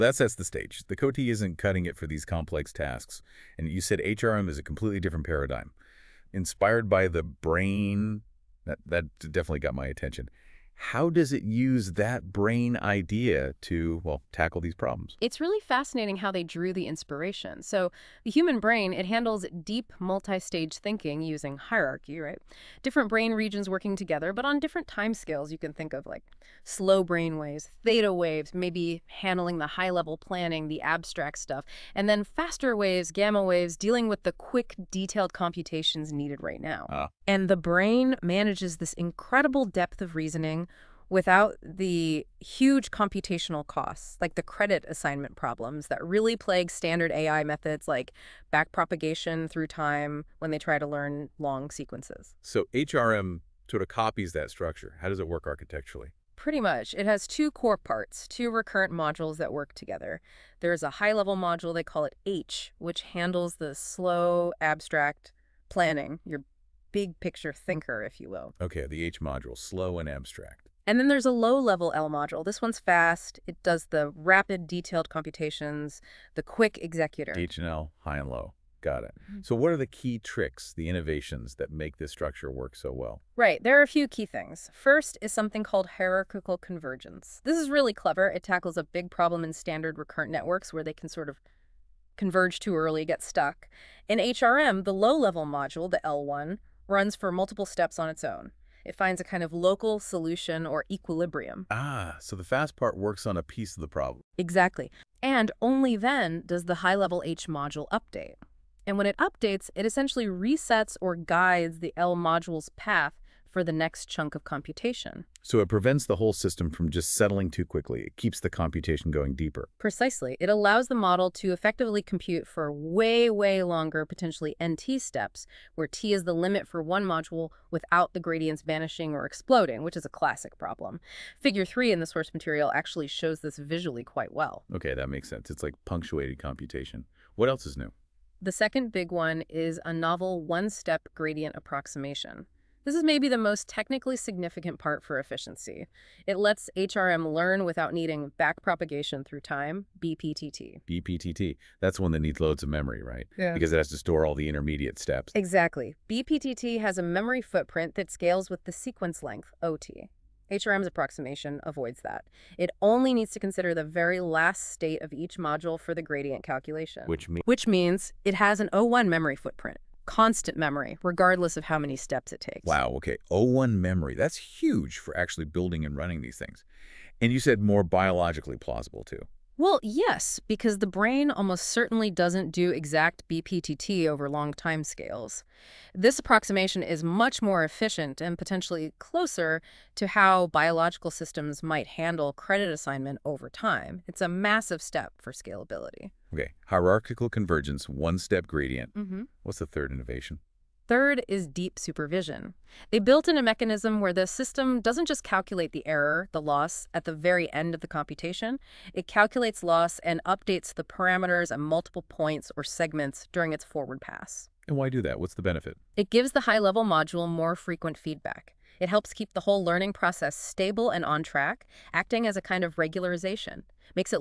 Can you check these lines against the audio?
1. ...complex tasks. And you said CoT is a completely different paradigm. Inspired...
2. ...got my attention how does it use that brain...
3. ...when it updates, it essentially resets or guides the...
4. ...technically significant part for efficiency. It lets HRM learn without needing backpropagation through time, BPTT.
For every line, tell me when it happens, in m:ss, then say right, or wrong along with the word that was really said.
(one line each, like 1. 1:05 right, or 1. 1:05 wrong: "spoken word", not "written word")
1. 0:02 wrong: "HRM", not "CoT"
2. 0:09 right
3. 1:48 right
4. 2:23 right.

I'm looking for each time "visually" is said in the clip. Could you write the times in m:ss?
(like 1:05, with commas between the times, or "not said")
2:13.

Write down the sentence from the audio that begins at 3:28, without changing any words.
It calculates loss and updates the parameters at multiple points or segments during its forward pass.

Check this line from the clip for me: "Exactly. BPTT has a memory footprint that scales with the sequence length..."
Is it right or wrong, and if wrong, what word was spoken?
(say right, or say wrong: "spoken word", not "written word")
right.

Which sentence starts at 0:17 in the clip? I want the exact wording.
So the human brain, it handles deep multi-stage thinking using hierarchy, right?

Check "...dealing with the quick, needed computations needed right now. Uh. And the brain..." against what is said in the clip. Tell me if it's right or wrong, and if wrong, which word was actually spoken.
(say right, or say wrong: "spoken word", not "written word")
wrong: "detailed", not "needed".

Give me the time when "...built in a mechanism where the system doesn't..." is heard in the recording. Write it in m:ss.
3:22.